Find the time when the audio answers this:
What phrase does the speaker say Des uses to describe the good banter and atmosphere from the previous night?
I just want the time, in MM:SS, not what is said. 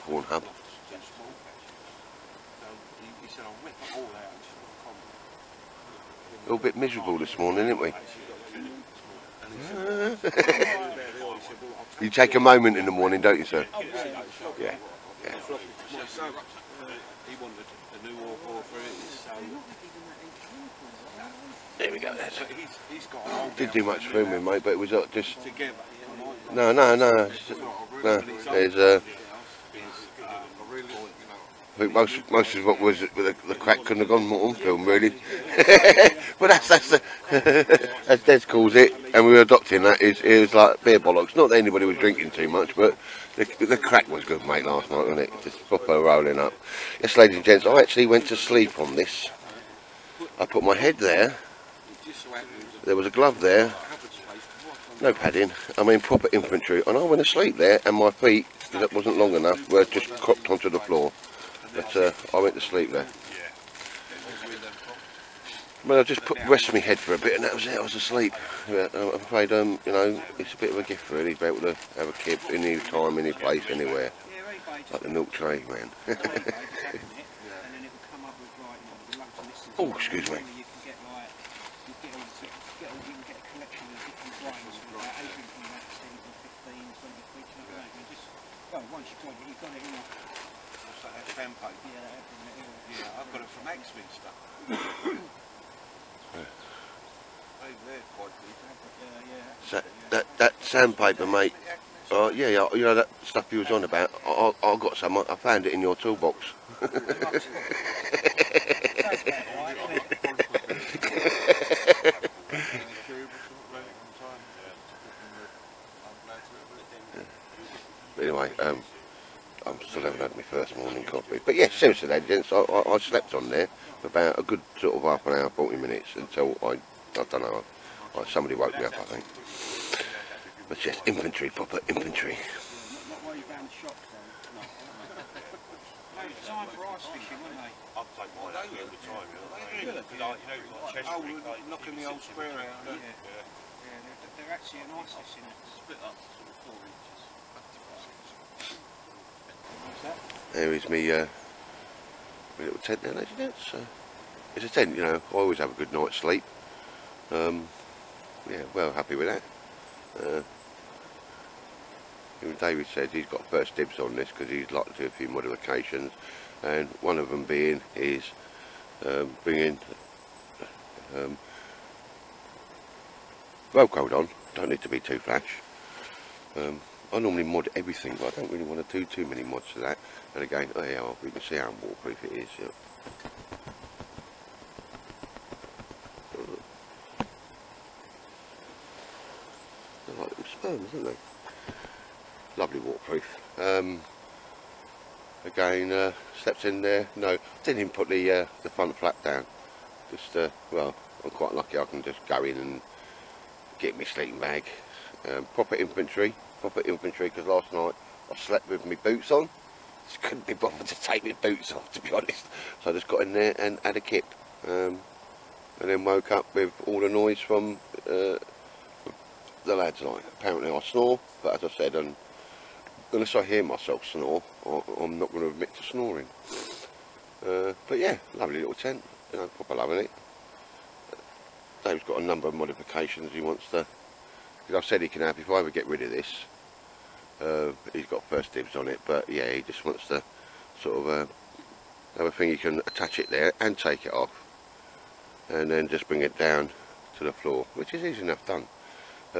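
00:40.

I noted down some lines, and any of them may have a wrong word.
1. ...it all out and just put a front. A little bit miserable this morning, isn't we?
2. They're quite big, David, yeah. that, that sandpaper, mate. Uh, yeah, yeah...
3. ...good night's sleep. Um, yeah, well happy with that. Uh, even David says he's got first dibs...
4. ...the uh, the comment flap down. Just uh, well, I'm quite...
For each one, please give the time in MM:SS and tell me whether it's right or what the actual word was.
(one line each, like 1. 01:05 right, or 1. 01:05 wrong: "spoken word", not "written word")
1. 00:03 wrong: "comment", not "front"
2. 01:37 wrong: "Yeah", not "David"
3. 02:35 right
4. 03:18 wrong: "front", not "comment".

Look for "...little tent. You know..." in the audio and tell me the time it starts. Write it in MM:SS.
03:48.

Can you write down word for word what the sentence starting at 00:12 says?
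you take a moment in the morning, don't you, sir?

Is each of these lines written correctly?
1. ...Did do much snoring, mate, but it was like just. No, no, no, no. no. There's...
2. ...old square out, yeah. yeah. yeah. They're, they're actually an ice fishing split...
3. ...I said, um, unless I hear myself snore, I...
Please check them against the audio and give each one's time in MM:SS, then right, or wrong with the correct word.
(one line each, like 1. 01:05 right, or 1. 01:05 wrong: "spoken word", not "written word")
1. 00:23 wrong: "filming", not "snoring"
2. 02:22 right
3. 03:41 right.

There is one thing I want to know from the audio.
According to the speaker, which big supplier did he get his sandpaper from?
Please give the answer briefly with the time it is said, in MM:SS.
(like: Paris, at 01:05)
Axminster, at 01:33.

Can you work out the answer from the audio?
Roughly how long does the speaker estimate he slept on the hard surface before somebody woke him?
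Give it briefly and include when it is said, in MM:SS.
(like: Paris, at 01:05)
40 minutes, at 02:05.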